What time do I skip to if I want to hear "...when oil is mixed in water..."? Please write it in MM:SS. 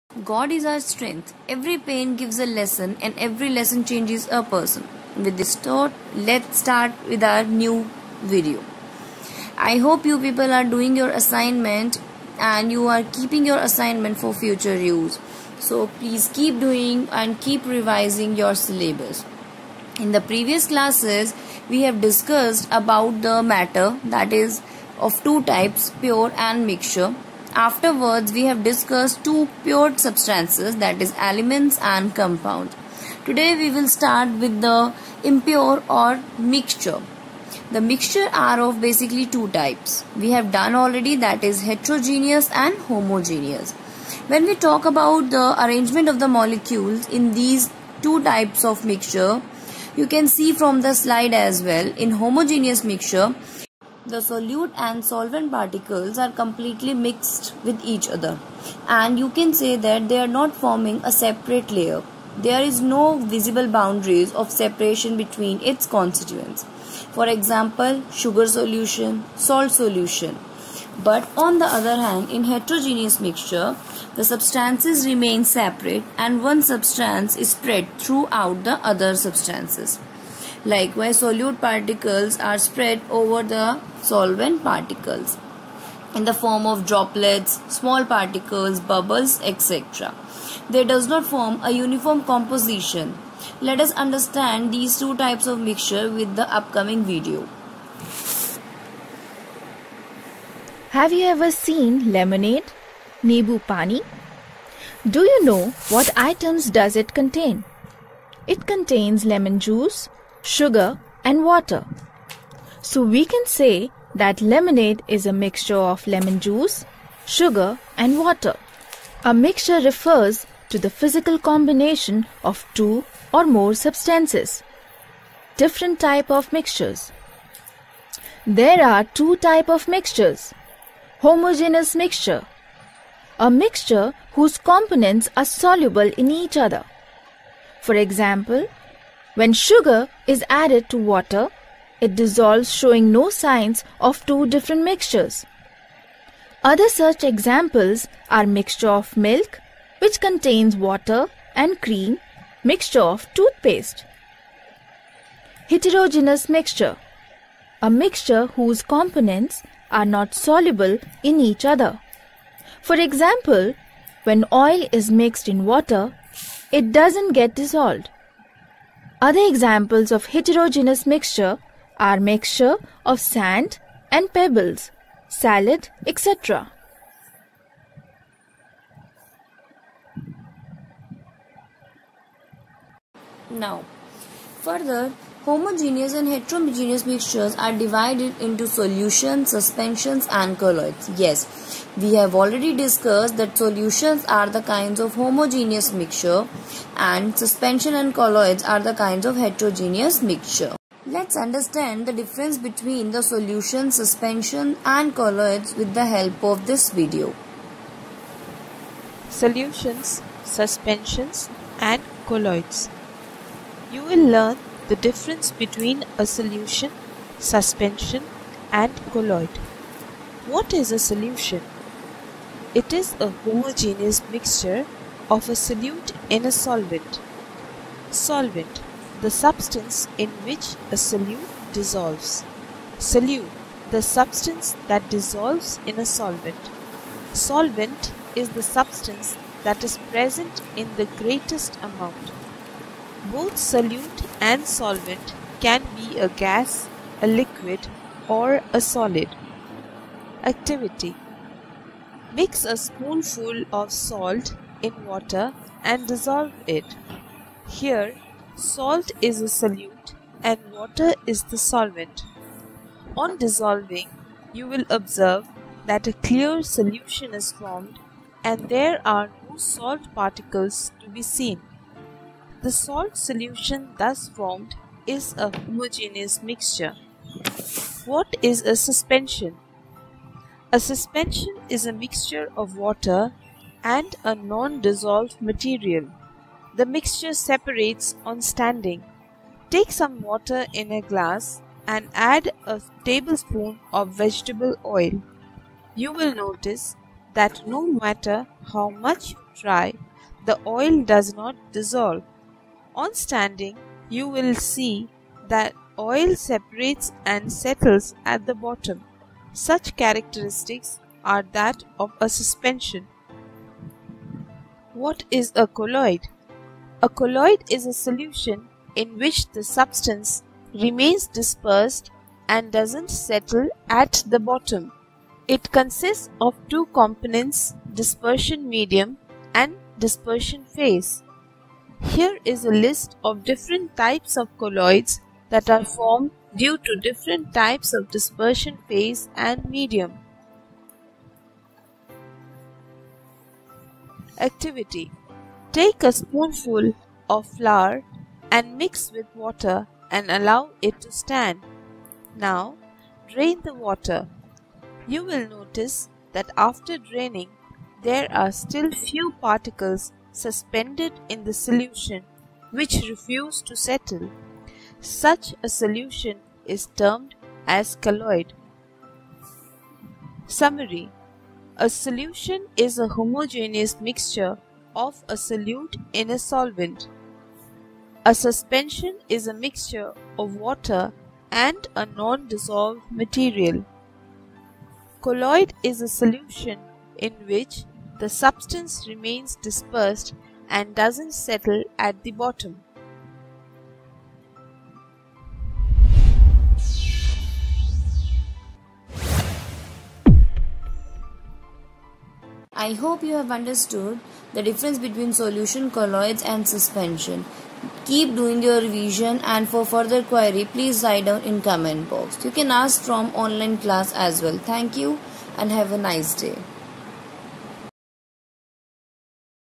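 02:44.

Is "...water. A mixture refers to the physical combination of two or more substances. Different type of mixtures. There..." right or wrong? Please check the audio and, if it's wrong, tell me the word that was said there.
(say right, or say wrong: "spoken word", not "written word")
right.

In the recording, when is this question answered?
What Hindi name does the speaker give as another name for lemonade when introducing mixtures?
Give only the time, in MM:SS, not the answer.
01:43.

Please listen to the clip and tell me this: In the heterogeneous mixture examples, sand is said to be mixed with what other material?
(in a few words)
pebbles.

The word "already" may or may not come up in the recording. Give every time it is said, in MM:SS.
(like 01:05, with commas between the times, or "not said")
00:40, 03:12.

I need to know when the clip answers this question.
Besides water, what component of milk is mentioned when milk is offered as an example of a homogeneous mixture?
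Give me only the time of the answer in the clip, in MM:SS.
02:31.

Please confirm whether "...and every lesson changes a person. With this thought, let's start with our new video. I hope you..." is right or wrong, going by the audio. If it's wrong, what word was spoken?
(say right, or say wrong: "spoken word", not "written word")
right.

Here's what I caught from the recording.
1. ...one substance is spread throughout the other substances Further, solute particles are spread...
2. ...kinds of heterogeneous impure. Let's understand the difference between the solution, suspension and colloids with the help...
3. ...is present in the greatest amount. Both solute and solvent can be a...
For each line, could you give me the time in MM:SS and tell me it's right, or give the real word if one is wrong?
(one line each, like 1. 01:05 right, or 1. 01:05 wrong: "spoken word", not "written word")
1. 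01:16 wrong: "Likewise", not "Further"
2. 03:18 wrong: "mixture", not "impure"
3. 03:59 right.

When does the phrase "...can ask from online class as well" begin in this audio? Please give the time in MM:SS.
06:52.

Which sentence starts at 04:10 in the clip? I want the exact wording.
Activity Mix a spoonful of salt in water and dissolve it.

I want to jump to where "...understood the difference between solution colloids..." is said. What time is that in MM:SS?
06:43.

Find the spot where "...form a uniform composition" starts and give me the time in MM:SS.
01:31.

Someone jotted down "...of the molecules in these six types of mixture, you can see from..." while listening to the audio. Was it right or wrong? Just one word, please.
wrong.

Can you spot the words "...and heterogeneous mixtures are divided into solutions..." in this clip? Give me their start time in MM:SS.
03:06.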